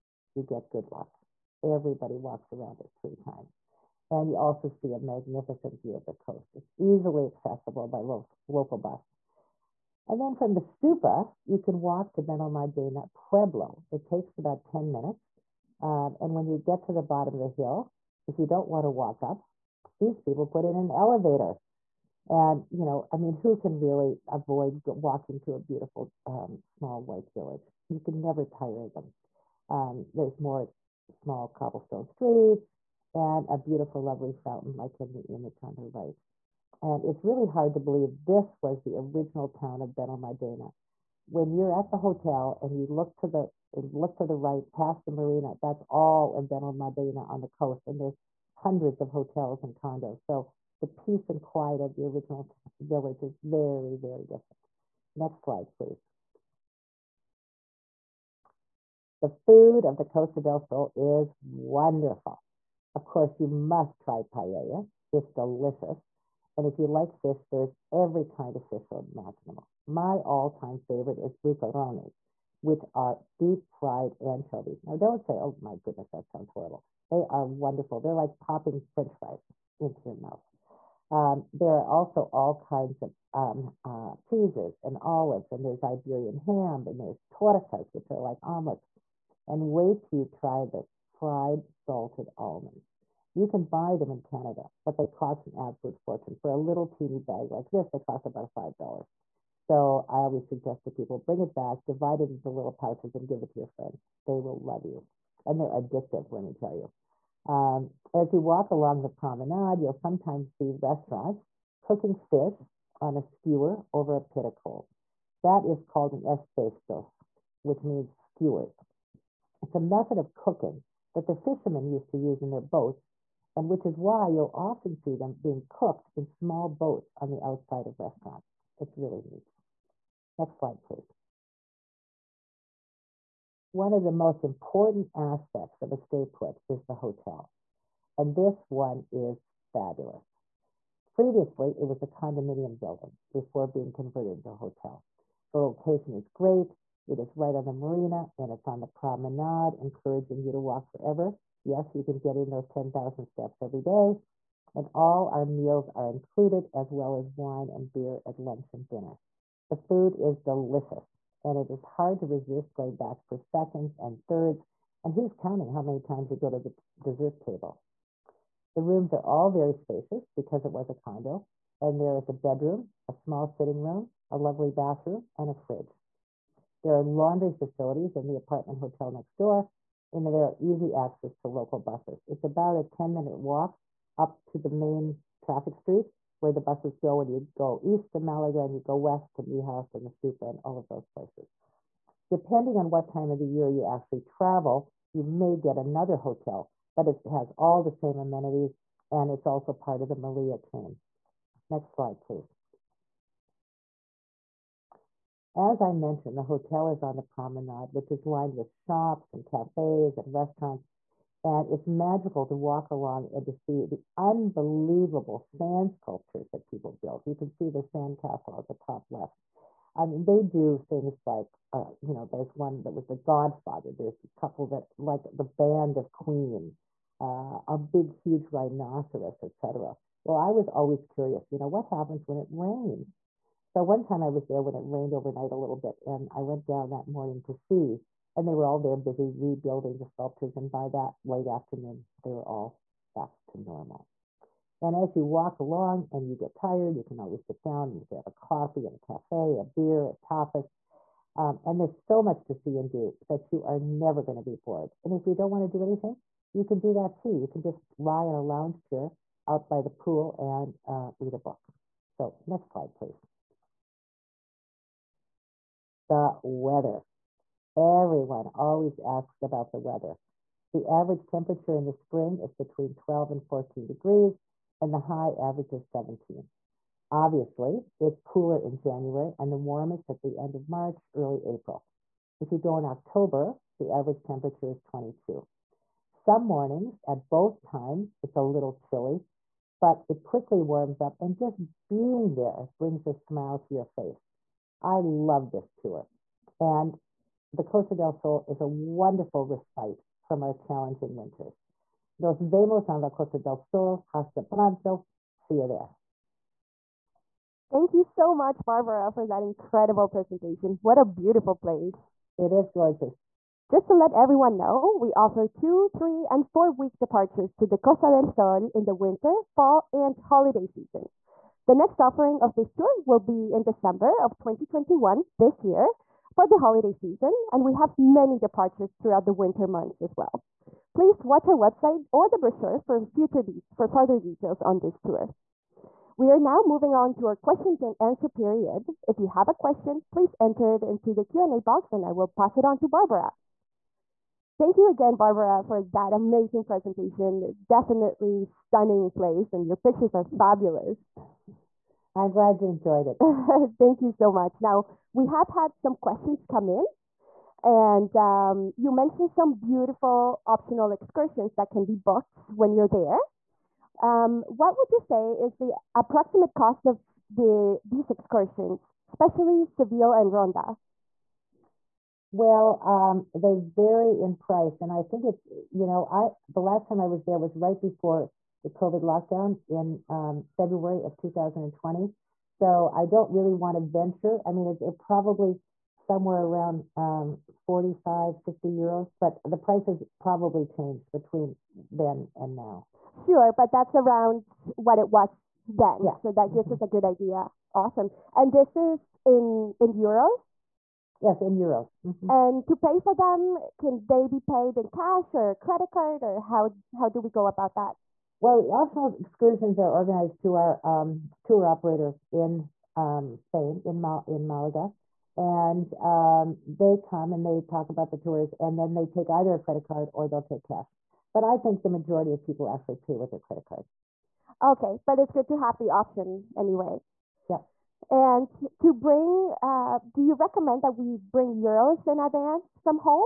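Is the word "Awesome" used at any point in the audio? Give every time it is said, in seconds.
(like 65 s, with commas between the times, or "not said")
397 s.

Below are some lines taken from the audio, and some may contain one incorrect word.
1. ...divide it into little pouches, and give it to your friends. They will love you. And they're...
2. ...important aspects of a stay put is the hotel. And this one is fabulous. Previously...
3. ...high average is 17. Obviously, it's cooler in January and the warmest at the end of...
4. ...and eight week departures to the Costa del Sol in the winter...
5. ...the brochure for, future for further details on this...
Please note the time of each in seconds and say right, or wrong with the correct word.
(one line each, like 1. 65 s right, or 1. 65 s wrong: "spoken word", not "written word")
1. 101 s right
2. 134 s right
3. 274 s right
4. 316 s wrong: "four", not "eight"
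5. 332 s right.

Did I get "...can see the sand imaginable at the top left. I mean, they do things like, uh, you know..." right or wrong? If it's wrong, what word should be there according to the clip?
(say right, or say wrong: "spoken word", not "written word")
wrong: "castle", not "imaginable".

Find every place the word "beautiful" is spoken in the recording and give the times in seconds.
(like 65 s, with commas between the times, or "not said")
25 s, 33 s, 311 s, 359 s.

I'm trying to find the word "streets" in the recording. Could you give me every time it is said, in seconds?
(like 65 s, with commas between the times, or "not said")
32 s, 185 s.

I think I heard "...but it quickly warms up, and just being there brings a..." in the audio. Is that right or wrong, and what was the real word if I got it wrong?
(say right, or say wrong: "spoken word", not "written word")
right.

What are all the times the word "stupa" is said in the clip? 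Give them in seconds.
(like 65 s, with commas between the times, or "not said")
10 s, 190 s.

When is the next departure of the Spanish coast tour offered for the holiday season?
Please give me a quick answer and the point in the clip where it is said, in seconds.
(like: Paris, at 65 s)
December 2021, at 323 s.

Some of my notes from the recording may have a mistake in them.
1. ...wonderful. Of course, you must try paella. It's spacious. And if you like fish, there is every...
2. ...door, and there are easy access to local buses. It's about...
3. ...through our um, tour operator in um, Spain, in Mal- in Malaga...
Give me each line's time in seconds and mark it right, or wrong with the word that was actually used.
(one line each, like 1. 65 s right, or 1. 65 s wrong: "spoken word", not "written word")
1. 61 s wrong: "delicious", not "spacious"
2. 179 s right
3. 410 s right.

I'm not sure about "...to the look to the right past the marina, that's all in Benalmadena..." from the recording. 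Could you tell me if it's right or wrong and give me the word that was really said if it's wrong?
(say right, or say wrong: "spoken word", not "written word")
right.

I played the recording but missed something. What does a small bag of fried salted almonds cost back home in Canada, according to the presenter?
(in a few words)
$5.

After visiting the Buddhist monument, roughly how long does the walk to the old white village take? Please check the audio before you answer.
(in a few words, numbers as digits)
10 minutes.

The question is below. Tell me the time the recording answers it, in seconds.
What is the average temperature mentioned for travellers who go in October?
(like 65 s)
284 s.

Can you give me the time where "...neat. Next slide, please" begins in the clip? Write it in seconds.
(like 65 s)
129 s.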